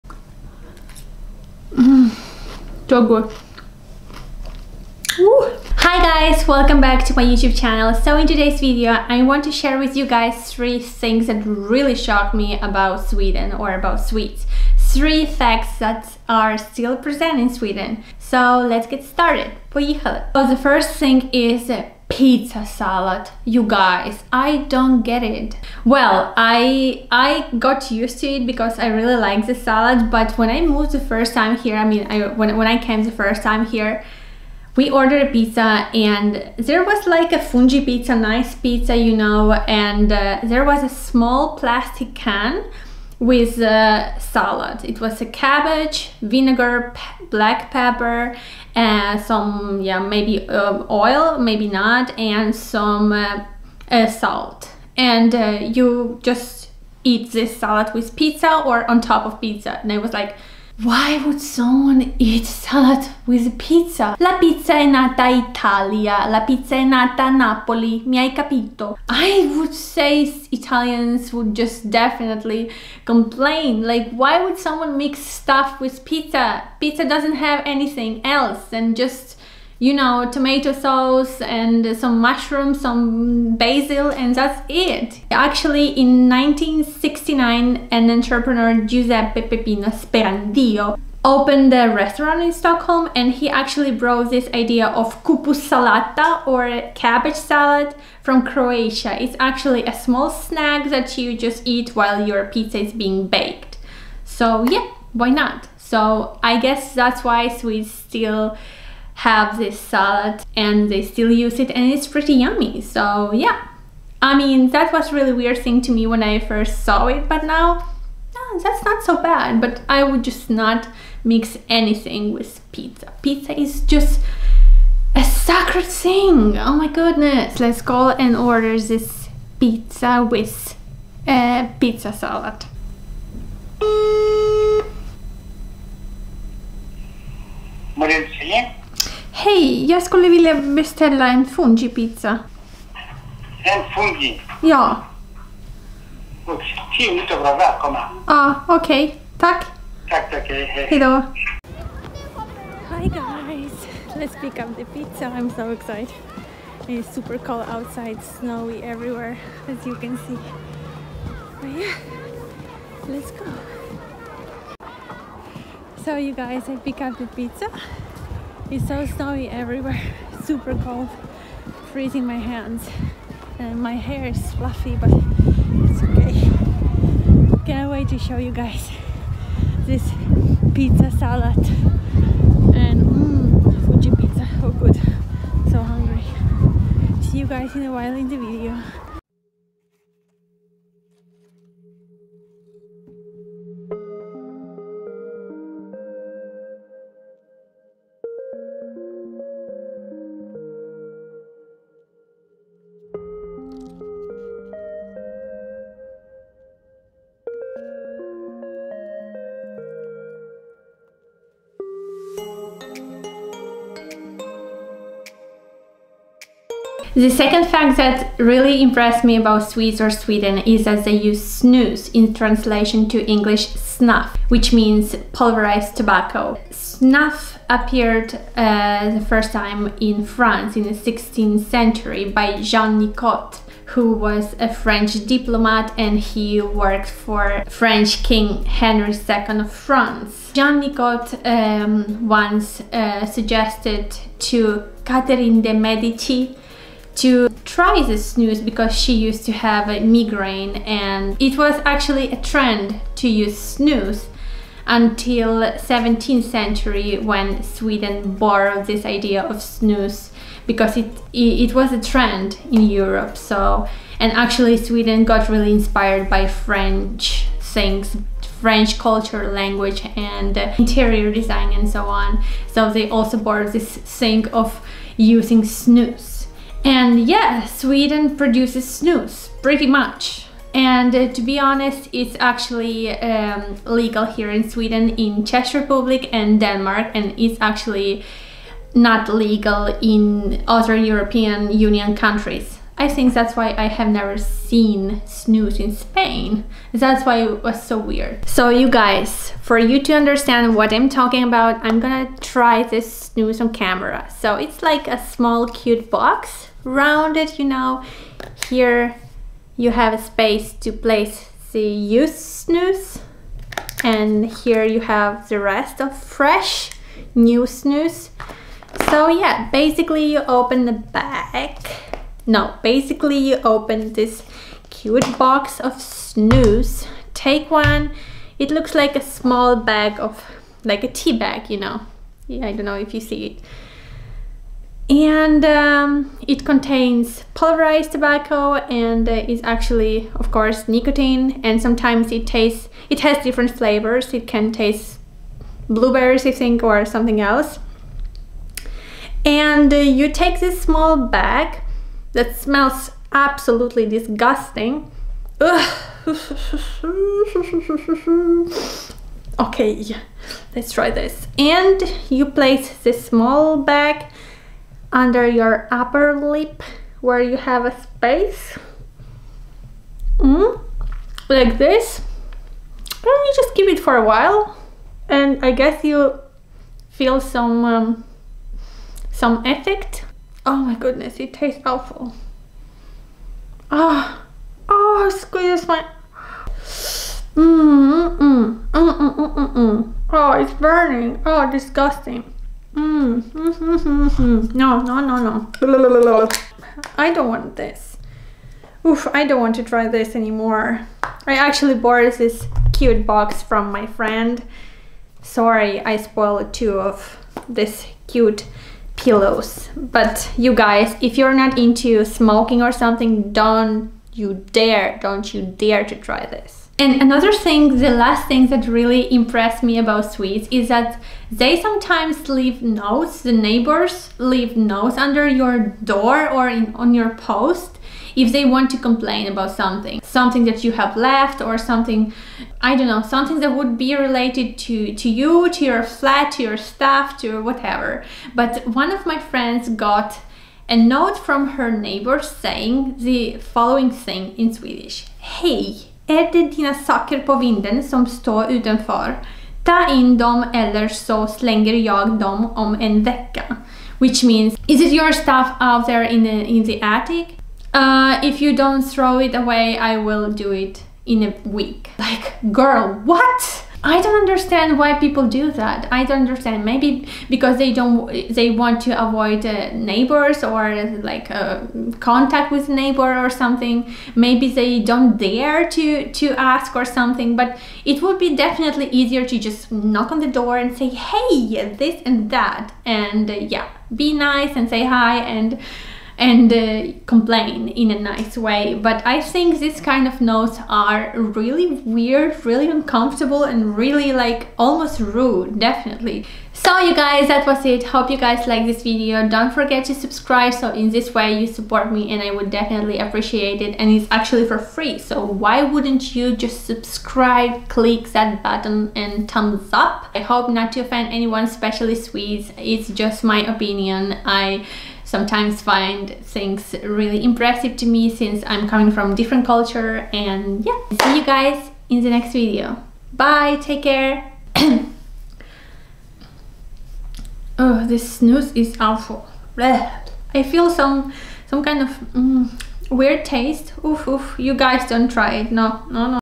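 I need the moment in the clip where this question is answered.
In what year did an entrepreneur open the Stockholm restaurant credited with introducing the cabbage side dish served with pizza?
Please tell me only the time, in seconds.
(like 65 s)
86 s.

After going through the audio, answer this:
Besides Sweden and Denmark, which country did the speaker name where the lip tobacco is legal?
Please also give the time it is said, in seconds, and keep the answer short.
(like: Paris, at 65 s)
Czech Republic, at 285 s.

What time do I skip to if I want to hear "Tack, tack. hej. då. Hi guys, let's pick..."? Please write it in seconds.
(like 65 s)
150 s.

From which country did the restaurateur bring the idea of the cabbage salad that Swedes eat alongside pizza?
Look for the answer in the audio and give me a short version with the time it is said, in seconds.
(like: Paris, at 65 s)
Croatia, at 98 s.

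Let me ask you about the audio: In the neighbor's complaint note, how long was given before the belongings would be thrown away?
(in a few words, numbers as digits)
A week.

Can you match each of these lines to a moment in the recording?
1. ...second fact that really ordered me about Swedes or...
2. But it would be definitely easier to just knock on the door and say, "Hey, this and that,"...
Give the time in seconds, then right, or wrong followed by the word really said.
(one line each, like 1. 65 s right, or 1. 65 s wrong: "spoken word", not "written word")
1. 217 s wrong: "impressed", not "ordered"
2. 477 s right.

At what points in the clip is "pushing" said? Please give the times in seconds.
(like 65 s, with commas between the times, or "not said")
not said.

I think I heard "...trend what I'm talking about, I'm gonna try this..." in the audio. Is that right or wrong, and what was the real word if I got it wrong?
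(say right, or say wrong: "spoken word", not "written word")
wrong: "understand", not "trend".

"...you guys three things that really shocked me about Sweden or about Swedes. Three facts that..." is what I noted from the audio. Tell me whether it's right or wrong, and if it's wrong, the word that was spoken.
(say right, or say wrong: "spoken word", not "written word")
right.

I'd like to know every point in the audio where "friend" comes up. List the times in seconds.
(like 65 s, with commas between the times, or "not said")
404 s, 439 s.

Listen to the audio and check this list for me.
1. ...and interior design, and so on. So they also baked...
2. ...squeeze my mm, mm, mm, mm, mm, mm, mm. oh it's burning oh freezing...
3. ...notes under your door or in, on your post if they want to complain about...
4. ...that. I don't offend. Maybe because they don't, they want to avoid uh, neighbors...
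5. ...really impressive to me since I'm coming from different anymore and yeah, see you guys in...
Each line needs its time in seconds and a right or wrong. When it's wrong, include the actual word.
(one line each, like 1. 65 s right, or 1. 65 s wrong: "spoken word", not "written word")
1. 270 s wrong: "borrowed", not "baked"
2. 385 s wrong: "disgusting", not "freezing"
3. 424 s right
4. 465 s wrong: "understand", not "offend"
5. 517 s wrong: "culture", not "anymore".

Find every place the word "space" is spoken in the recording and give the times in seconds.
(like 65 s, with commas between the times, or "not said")
310 s, 368 s.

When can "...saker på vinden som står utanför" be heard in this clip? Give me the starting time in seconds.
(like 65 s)
446 s.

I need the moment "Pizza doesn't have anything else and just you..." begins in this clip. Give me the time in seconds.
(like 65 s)
76 s.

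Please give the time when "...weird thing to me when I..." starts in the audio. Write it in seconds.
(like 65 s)
115 s.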